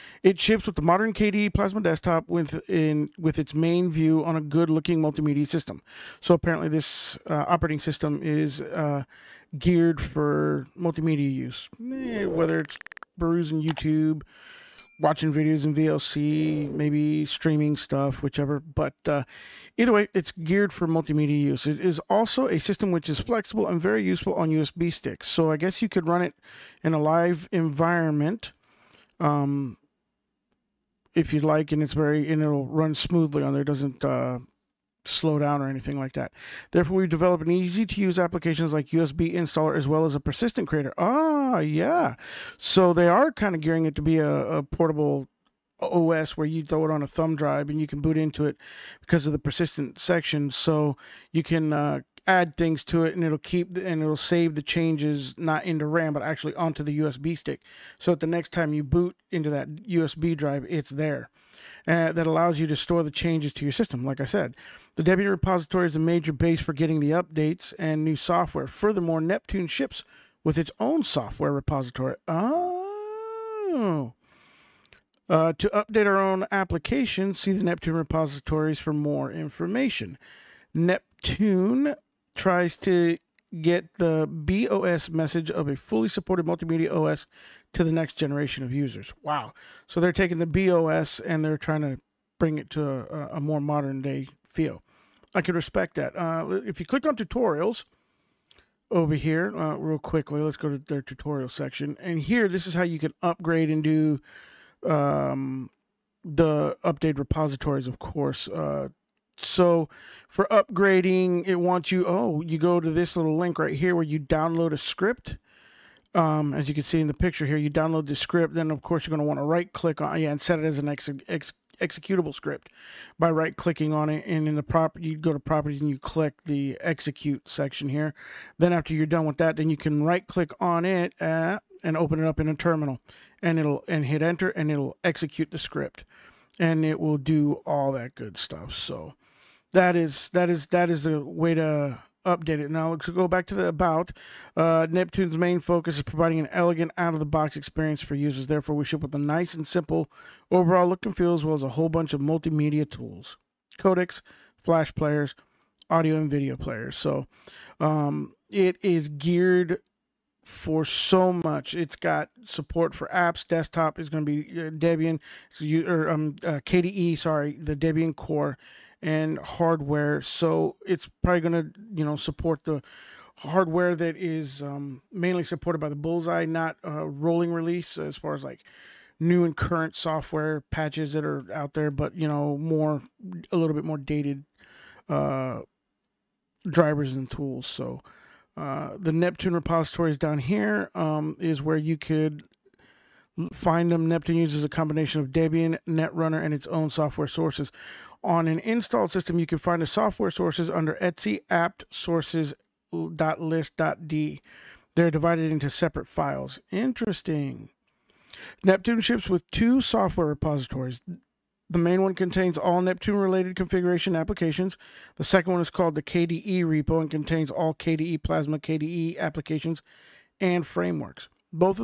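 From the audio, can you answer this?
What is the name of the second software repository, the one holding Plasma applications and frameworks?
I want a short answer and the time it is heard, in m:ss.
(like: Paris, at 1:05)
KDE repo, at 3:36.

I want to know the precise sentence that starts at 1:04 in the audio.
Like I said, the Debian repository is a major base for getting the updates and new software.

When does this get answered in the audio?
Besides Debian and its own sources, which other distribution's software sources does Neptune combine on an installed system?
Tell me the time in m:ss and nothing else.
3:15.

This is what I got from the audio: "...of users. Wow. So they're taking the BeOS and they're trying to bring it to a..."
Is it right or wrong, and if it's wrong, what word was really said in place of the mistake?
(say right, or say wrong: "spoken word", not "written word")
right.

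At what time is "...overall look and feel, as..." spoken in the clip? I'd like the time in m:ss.
2:30.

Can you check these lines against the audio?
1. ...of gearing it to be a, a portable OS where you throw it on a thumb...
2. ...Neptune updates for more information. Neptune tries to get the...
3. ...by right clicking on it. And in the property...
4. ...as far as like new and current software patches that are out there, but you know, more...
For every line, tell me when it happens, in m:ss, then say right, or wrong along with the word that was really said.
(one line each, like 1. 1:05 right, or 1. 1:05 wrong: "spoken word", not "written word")
1. 0:43 right
2. 1:17 wrong: "repositories", not "updates"
3. 2:03 right
4. 2:57 right.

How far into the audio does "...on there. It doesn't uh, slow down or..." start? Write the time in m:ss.
0:33.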